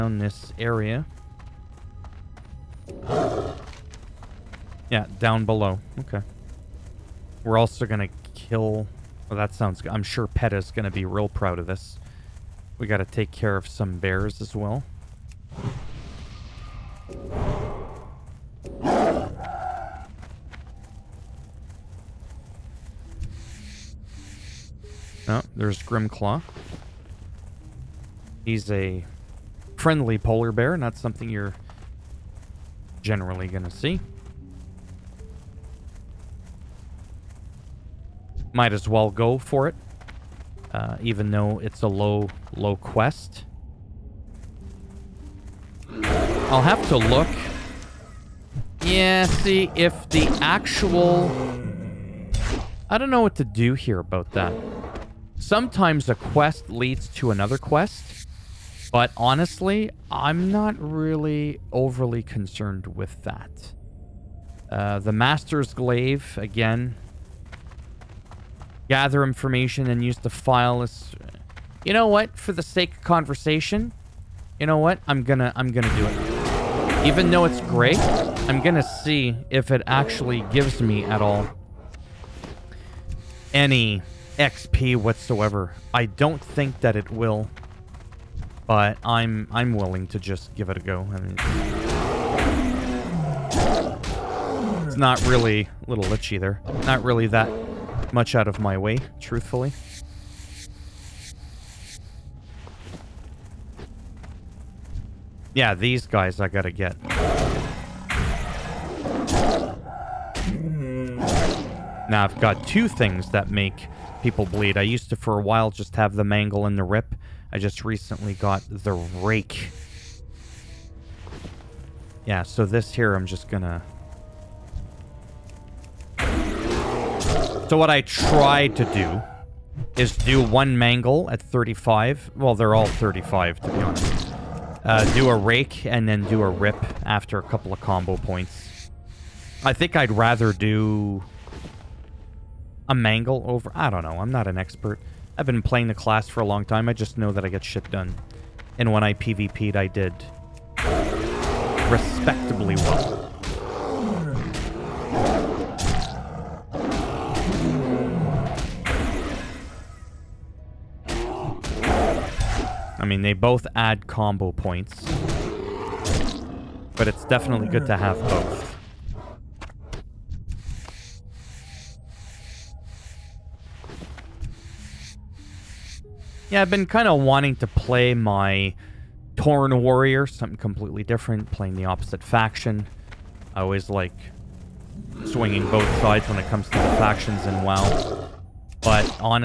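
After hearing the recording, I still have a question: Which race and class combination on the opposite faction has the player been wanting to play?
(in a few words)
Tauren Warrior.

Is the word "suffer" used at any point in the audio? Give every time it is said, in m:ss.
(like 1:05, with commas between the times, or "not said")
not said.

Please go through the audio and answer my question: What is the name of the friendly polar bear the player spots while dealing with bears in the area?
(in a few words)
Grimclaw.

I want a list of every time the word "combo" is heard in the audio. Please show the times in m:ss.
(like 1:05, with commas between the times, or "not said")
2:17, 2:44.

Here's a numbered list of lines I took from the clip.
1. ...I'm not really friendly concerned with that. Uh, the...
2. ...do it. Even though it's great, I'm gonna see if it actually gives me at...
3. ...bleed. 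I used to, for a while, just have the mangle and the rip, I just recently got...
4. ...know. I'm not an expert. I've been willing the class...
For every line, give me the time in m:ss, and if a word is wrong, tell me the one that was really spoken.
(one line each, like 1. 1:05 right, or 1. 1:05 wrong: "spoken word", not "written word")
1. 1:00 wrong: "overly", not "friendly"
2. 1:15 right
3. 1:54 right
4. 2:24 wrong: "playing", not "willing".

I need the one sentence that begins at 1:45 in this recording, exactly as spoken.
Yeah, these guys I gotta get.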